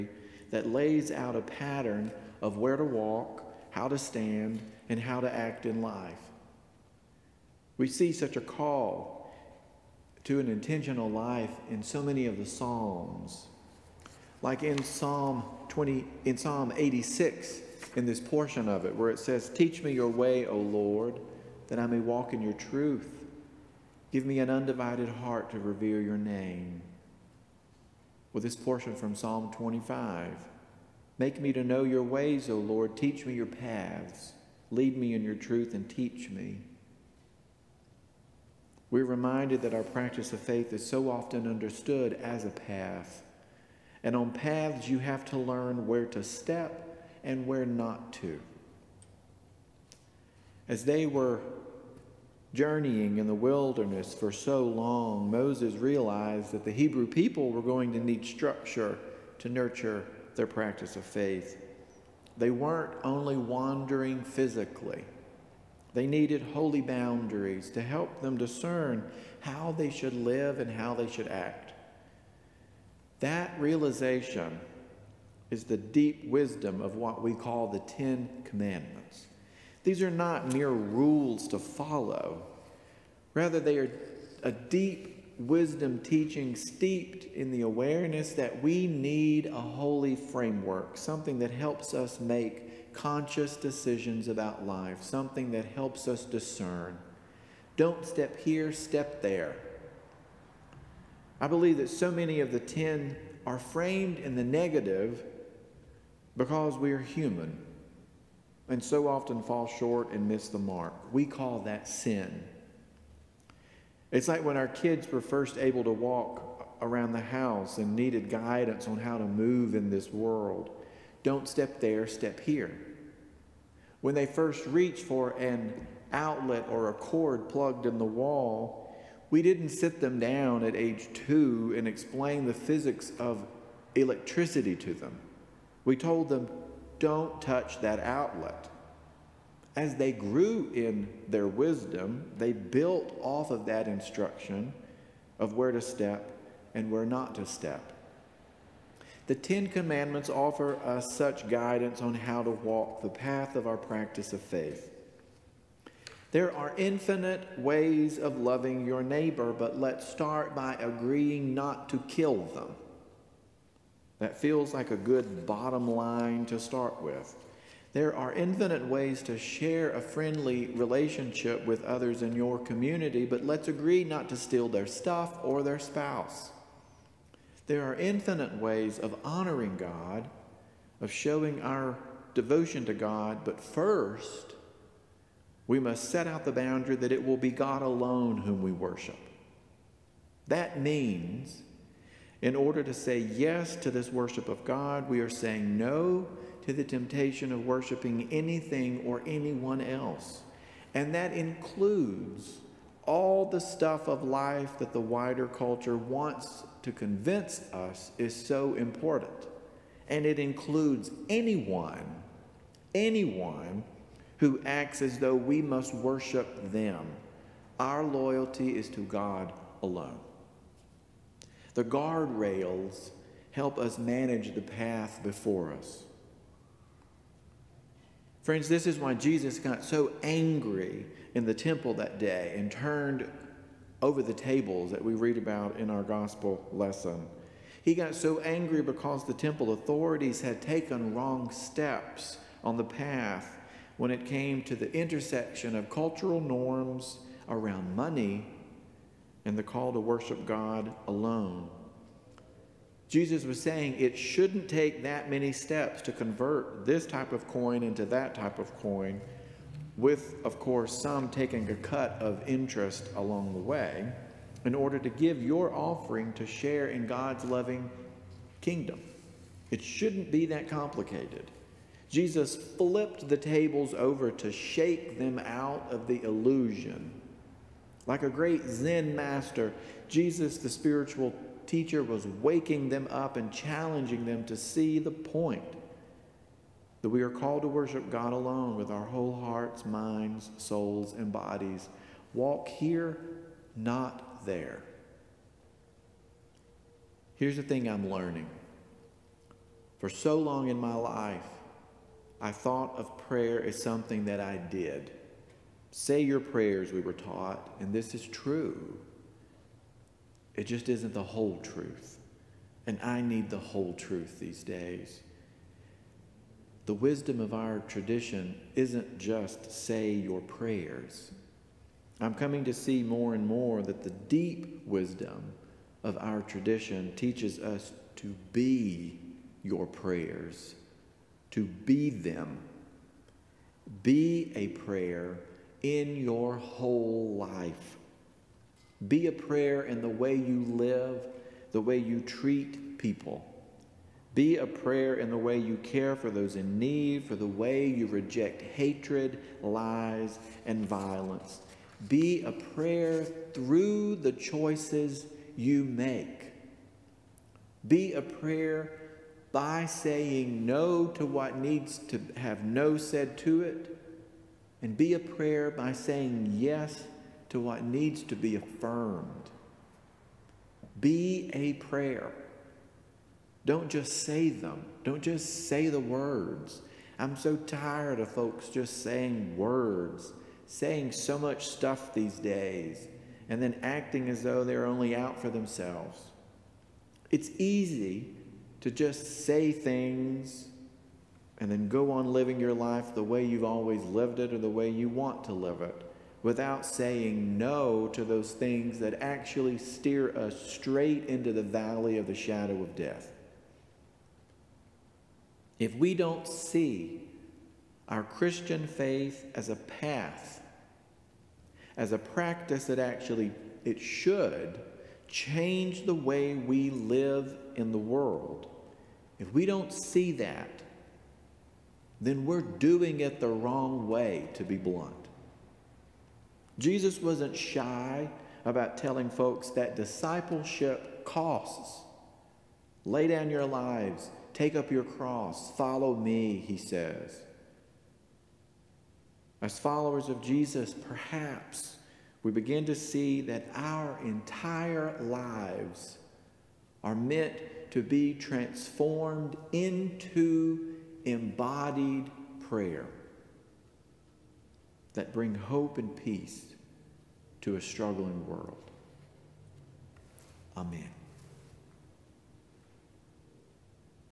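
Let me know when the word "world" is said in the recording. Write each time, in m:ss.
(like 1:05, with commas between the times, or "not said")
2:00, 6:57, 7:38.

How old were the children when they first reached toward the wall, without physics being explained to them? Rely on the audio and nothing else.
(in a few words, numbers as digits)
2.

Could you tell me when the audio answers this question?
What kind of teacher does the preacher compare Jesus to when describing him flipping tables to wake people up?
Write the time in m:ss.
4:38.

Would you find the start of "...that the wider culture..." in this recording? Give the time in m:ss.
3:24.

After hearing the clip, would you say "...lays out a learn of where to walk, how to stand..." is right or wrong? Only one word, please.
wrong.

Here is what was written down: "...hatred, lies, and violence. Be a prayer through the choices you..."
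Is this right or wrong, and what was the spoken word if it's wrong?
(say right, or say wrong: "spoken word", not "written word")
right.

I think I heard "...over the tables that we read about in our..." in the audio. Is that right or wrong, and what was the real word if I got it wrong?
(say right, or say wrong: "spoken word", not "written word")
right.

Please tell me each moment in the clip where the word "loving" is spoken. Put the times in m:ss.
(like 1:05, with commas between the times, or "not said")
2:38, 4:27.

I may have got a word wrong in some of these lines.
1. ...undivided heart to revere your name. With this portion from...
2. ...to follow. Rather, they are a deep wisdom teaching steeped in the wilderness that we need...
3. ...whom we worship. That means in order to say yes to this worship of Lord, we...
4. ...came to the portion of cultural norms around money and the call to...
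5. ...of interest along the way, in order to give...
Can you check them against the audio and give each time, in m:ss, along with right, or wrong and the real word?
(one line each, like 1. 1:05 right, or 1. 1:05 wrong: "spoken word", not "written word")
1. 0:24 right
2. 1:21 wrong: "awareness", not "wilderness"
3. 3:08 wrong: "God", not "Lord"
4. 4:04 wrong: "intersection", not "portion"
5. 4:22 right.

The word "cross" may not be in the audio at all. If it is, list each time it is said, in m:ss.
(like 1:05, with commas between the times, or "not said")
7:15.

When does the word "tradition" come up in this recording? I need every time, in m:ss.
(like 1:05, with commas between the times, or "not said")
5:17, 5:26.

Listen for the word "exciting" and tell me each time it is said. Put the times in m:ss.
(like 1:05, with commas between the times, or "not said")
not said.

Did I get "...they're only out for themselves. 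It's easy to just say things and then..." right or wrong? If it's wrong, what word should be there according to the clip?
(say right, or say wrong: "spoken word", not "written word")
right.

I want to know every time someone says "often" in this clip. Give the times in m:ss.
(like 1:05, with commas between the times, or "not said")
0:41, 1:49.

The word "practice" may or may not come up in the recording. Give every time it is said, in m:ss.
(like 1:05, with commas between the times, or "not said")
0:39, 1:00, 2:33, 6:52.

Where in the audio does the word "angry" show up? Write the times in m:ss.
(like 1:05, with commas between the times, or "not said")
3:50, 3:58.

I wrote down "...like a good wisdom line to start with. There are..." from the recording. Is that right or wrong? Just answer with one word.
wrong.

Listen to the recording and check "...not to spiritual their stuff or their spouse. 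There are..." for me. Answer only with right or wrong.
wrong.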